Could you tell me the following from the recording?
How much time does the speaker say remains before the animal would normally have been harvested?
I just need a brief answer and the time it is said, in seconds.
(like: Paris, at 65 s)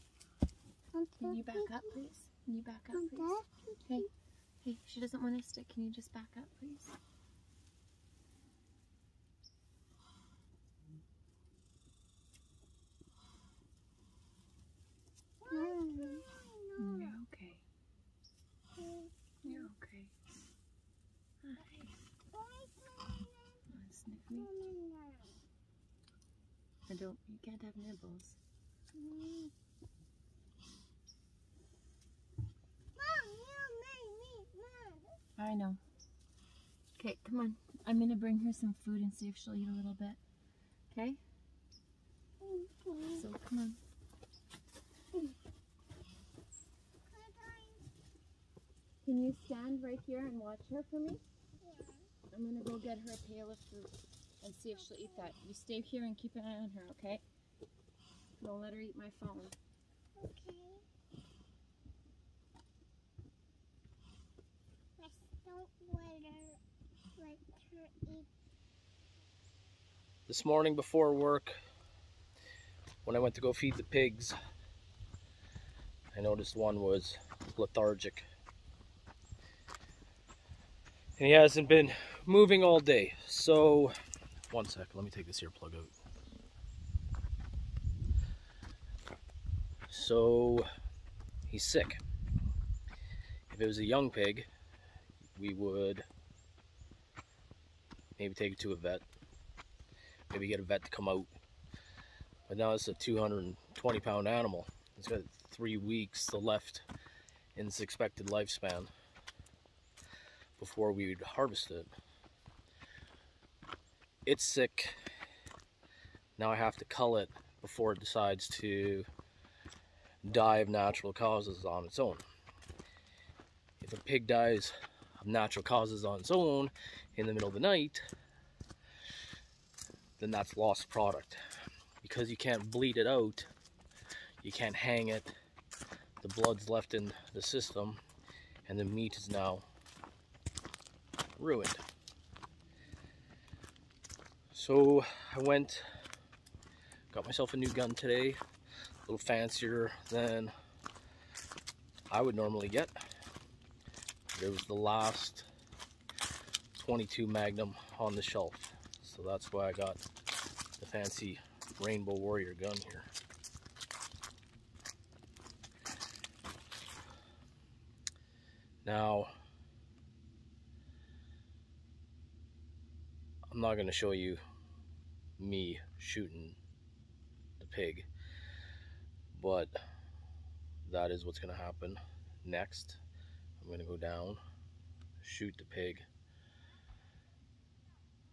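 3 weeks, at 105 s.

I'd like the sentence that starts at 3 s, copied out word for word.
Hey, hey, she doesn't want to stick.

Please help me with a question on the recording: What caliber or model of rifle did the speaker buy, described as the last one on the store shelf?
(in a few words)
.22 Magnum.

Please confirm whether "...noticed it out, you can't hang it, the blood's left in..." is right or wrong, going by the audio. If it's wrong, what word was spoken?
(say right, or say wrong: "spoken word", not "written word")
wrong: "bleed", not "noticed".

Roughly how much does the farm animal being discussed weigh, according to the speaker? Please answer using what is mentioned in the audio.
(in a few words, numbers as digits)
220 pounds.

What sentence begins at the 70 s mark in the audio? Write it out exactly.
This morning before work, when I went to go feed the pigs, I noticed one was lethargic.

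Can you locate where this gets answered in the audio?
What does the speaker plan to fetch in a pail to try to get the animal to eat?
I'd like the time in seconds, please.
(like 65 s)
53 s.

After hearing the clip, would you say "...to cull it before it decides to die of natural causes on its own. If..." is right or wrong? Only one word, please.
right.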